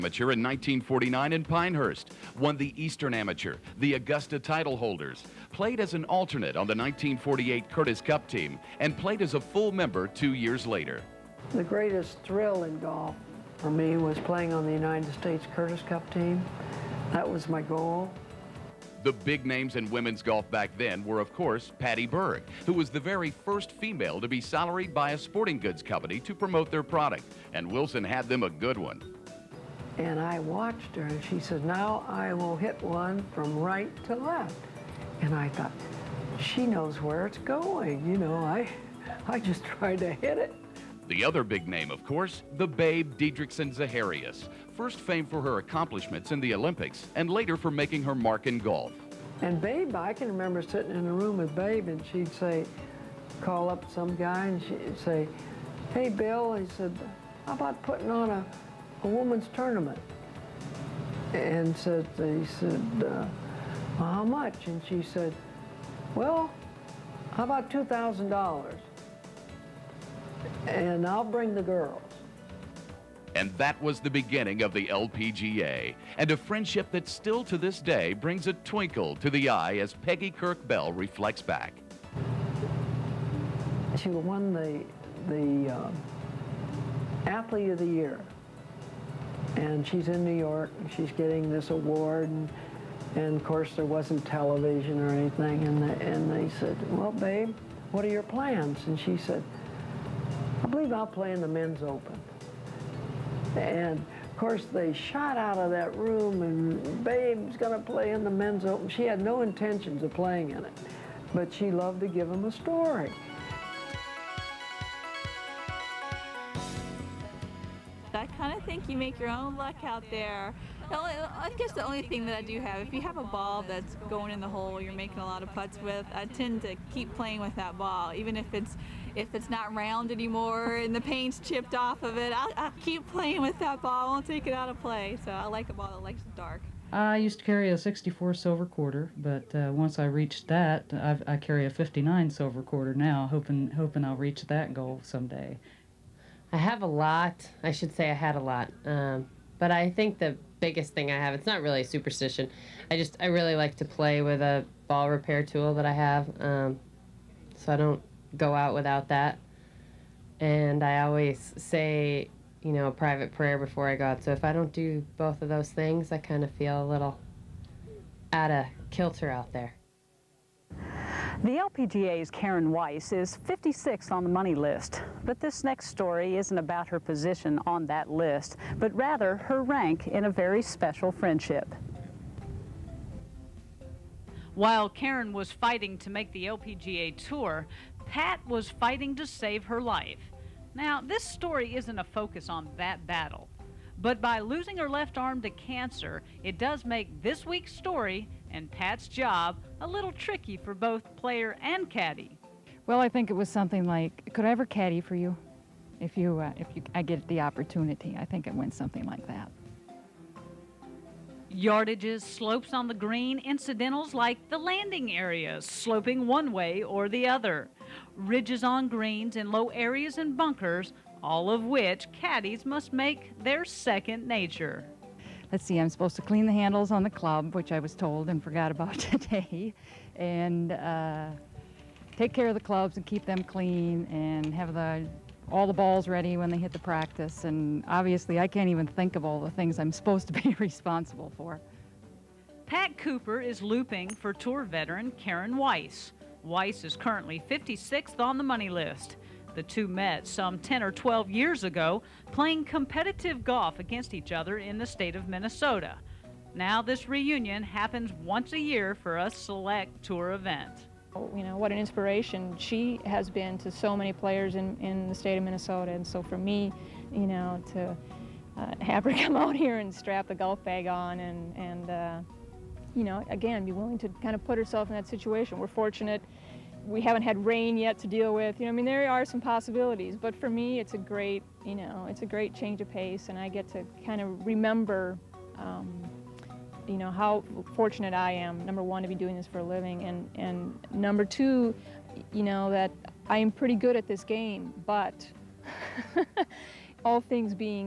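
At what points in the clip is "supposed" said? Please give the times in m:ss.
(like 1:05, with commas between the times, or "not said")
3:45, 3:59.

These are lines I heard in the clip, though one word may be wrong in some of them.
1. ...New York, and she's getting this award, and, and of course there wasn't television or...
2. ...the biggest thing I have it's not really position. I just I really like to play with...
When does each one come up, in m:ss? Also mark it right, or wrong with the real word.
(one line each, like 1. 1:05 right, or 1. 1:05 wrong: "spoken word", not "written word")
1. 1:30 right
2. 2:30 wrong: "superstition", not "position".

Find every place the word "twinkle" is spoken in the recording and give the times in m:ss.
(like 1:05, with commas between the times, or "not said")
1:18.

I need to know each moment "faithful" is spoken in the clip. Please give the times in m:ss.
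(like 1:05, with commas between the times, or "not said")
not said.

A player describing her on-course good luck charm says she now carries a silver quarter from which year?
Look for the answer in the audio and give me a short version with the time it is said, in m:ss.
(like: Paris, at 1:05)
1959, at 2:21.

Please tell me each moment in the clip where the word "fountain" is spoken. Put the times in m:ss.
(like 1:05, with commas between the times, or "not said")
not said.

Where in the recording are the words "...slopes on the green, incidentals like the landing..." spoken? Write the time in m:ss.
3:32.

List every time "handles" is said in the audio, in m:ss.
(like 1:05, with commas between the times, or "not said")
3:46.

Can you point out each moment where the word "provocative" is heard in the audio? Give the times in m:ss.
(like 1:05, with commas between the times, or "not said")
not said.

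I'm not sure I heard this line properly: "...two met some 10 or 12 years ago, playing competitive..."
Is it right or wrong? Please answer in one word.
right.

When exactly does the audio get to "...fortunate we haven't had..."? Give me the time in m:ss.
4:35.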